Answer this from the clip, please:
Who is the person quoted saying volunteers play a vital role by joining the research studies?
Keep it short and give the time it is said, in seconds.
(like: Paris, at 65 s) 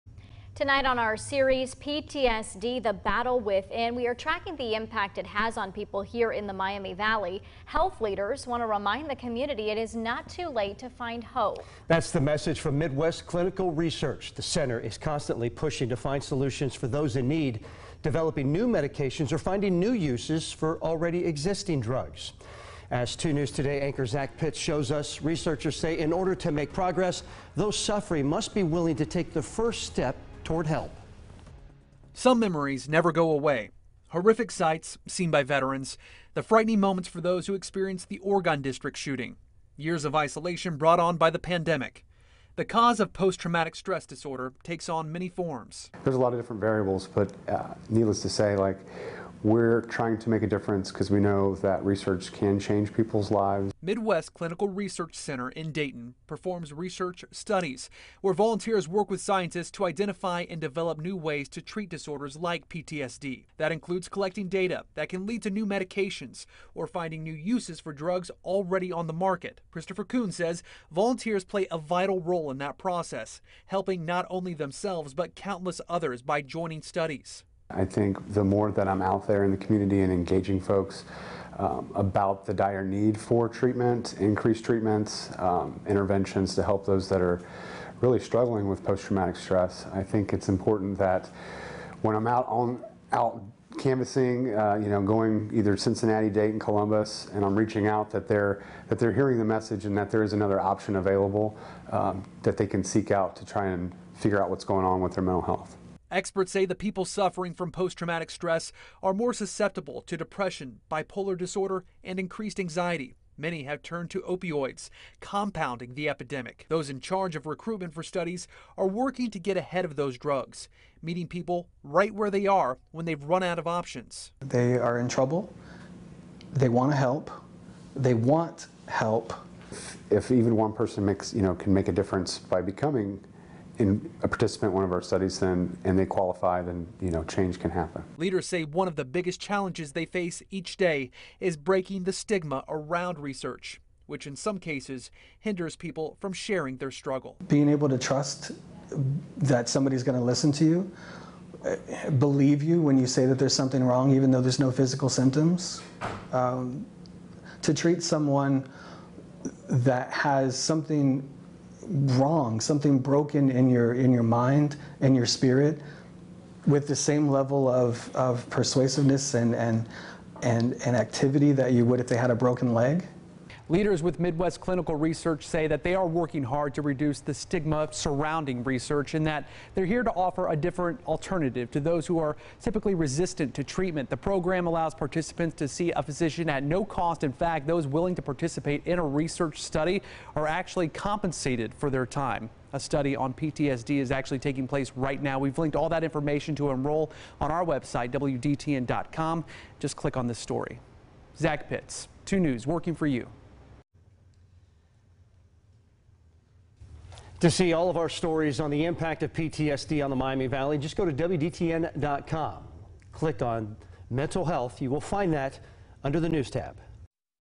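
Christopher Kuhn, at 69 s.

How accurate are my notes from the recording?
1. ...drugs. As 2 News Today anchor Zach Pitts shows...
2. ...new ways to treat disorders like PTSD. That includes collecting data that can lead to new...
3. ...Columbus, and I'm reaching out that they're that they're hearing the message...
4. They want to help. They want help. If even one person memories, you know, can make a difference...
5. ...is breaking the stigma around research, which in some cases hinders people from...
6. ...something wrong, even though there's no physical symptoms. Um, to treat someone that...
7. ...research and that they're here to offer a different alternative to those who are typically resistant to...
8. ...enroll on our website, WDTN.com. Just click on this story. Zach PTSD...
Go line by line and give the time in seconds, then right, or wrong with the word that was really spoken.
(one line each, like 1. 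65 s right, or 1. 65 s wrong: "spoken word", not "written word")
1. 21 s right
2. 60 s right
3. 96 s right
4. 126 s wrong: "makes", not "memories"
5. 141 s right
6. 153 s right
7. 178 s right
8. 196 s wrong: "Pitts", not "PTSD".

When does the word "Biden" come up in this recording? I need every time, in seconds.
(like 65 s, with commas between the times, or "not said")
not said.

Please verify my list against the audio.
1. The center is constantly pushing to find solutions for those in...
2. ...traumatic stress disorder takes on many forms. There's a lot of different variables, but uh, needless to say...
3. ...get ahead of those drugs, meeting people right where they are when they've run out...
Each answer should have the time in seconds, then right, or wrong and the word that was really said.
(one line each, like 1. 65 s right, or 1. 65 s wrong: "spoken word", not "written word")
1. 14 s right
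2. 43 s right
3. 119 s right.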